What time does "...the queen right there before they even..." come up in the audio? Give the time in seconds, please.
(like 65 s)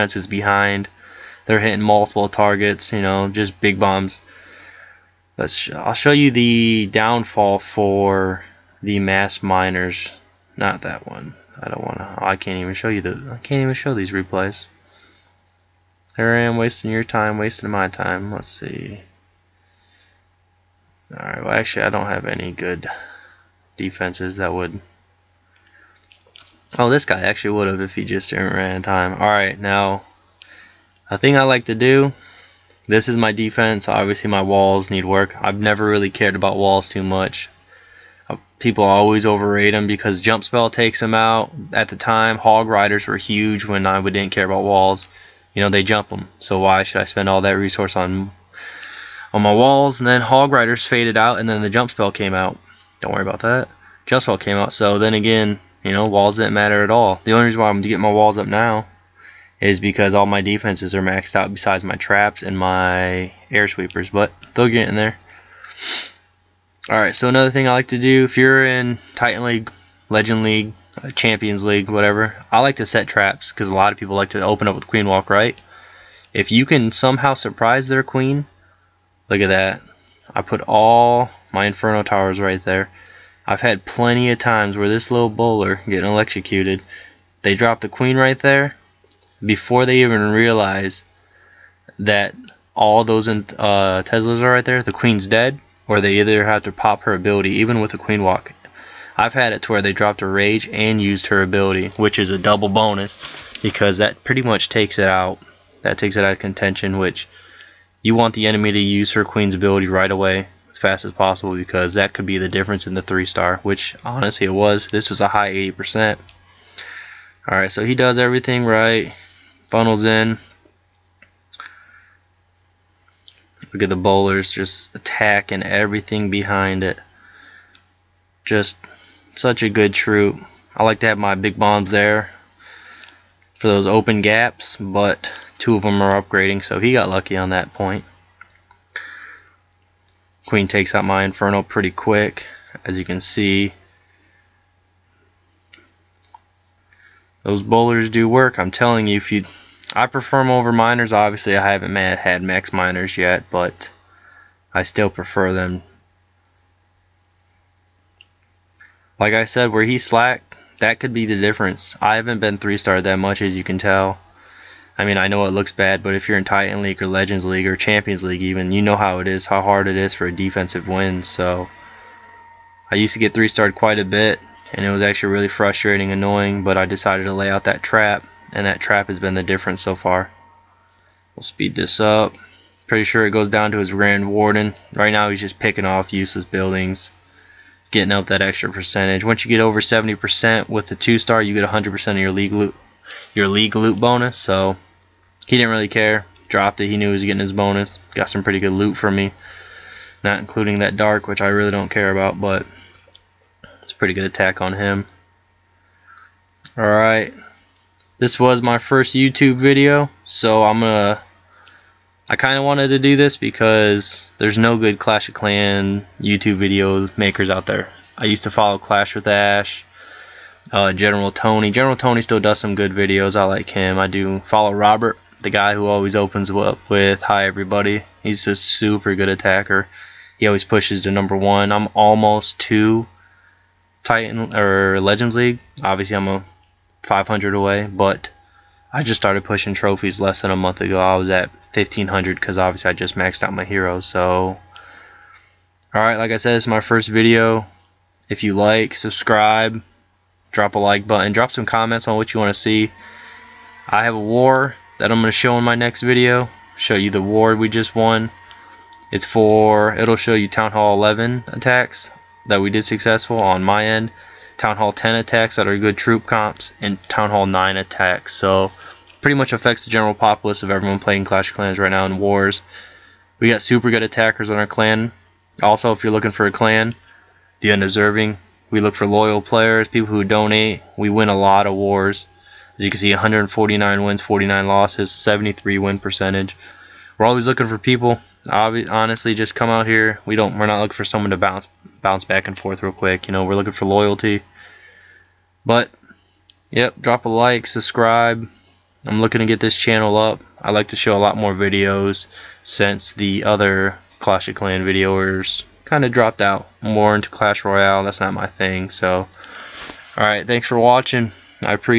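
87 s.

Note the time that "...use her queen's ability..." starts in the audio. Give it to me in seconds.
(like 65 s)
108 s.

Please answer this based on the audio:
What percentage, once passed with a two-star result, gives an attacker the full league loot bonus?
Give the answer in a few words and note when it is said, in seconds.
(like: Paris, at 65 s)
70%, at 189 s.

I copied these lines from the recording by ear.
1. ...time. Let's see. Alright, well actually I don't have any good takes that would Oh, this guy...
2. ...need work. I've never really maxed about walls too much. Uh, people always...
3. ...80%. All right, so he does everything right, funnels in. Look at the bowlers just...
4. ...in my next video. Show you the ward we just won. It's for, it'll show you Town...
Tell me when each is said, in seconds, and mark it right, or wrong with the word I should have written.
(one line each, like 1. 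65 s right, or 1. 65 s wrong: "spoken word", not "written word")
1. 17 s wrong: "defenses", not "takes"
2. 34 s wrong: "cared", not "maxed"
3. 115 s right
4. 255 s right.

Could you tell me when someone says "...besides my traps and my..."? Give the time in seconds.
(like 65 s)
61 s.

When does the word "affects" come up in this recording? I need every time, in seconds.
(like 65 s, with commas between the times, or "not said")
269 s.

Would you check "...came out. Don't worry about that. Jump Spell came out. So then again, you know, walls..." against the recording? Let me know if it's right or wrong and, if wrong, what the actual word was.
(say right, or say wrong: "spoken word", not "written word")
right.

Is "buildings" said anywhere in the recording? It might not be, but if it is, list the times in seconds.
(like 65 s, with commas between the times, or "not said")
186 s.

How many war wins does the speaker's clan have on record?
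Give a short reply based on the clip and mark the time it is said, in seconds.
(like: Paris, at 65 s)
149, at 283 s.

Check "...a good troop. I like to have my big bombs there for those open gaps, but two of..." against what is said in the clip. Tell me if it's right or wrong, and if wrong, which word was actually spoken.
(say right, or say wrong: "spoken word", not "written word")
right.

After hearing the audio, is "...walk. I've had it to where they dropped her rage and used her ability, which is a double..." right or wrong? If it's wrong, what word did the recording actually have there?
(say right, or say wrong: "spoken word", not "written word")
right.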